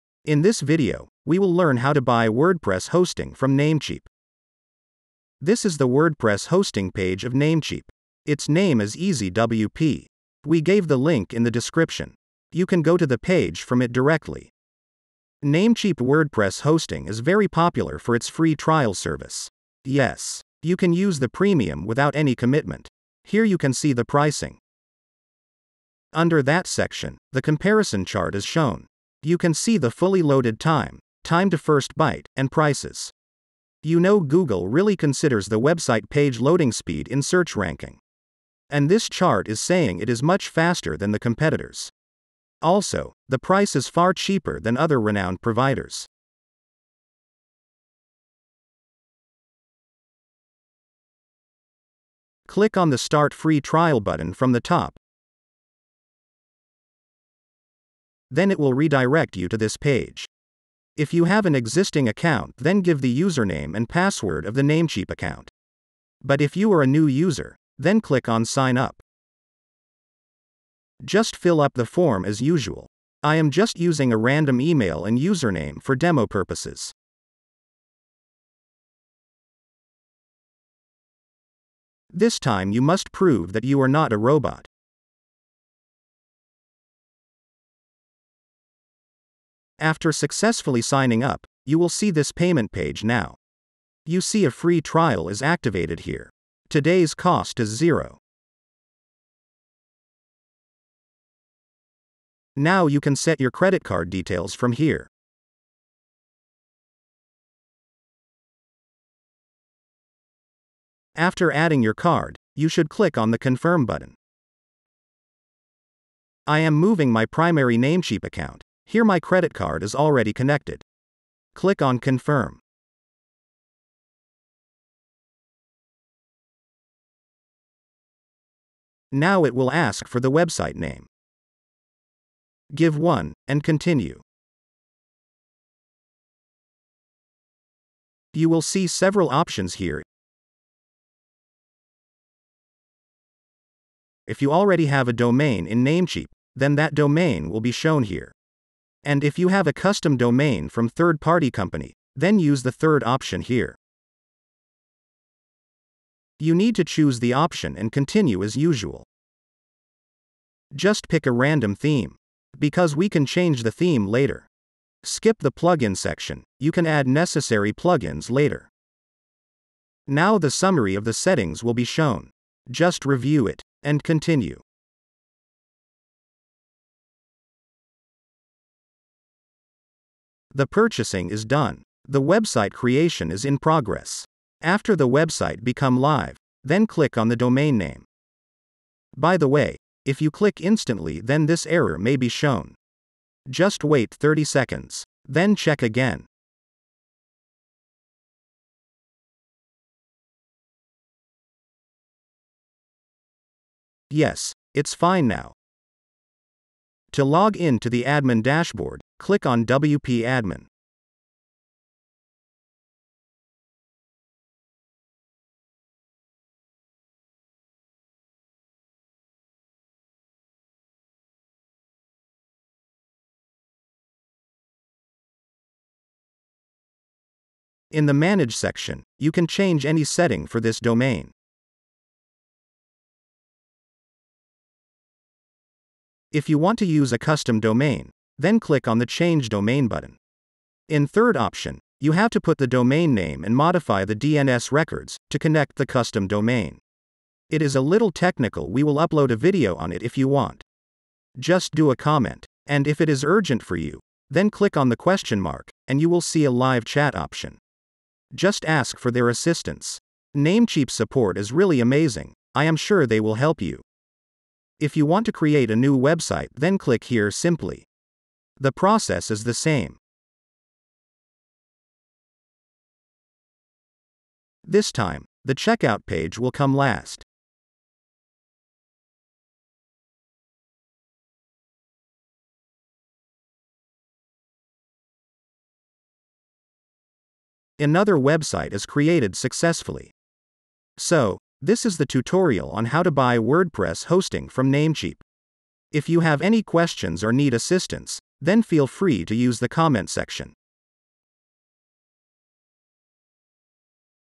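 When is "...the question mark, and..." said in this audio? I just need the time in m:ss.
4:14.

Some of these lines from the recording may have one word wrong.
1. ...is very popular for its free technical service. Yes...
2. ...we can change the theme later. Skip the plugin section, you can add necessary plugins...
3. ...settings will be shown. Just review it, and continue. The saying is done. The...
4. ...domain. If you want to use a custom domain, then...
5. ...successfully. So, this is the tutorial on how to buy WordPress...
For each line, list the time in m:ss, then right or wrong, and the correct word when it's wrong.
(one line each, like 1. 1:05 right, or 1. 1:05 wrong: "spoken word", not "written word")
1. 0:17 wrong: "trial", not "technical"
2. 2:42 right
3. 2:51 wrong: "purchasing", not "saying"
4. 3:50 right
5. 4:49 right.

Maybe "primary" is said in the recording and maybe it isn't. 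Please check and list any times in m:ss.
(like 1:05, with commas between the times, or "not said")
1:57.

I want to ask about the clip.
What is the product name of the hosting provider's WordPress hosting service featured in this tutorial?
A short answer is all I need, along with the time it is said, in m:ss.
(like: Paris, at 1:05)
EasyWP, at 0:08.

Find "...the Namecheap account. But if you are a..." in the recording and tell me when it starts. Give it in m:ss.
1:04.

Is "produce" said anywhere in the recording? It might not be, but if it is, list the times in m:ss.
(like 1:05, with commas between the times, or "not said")
not said.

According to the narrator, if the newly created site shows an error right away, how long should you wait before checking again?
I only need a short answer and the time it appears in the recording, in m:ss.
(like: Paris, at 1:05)
30 seconds, at 3:14.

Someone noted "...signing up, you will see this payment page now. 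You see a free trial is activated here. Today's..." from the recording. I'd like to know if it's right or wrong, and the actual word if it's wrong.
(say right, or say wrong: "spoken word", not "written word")
right.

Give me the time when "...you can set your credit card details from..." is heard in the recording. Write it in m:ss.
1:42.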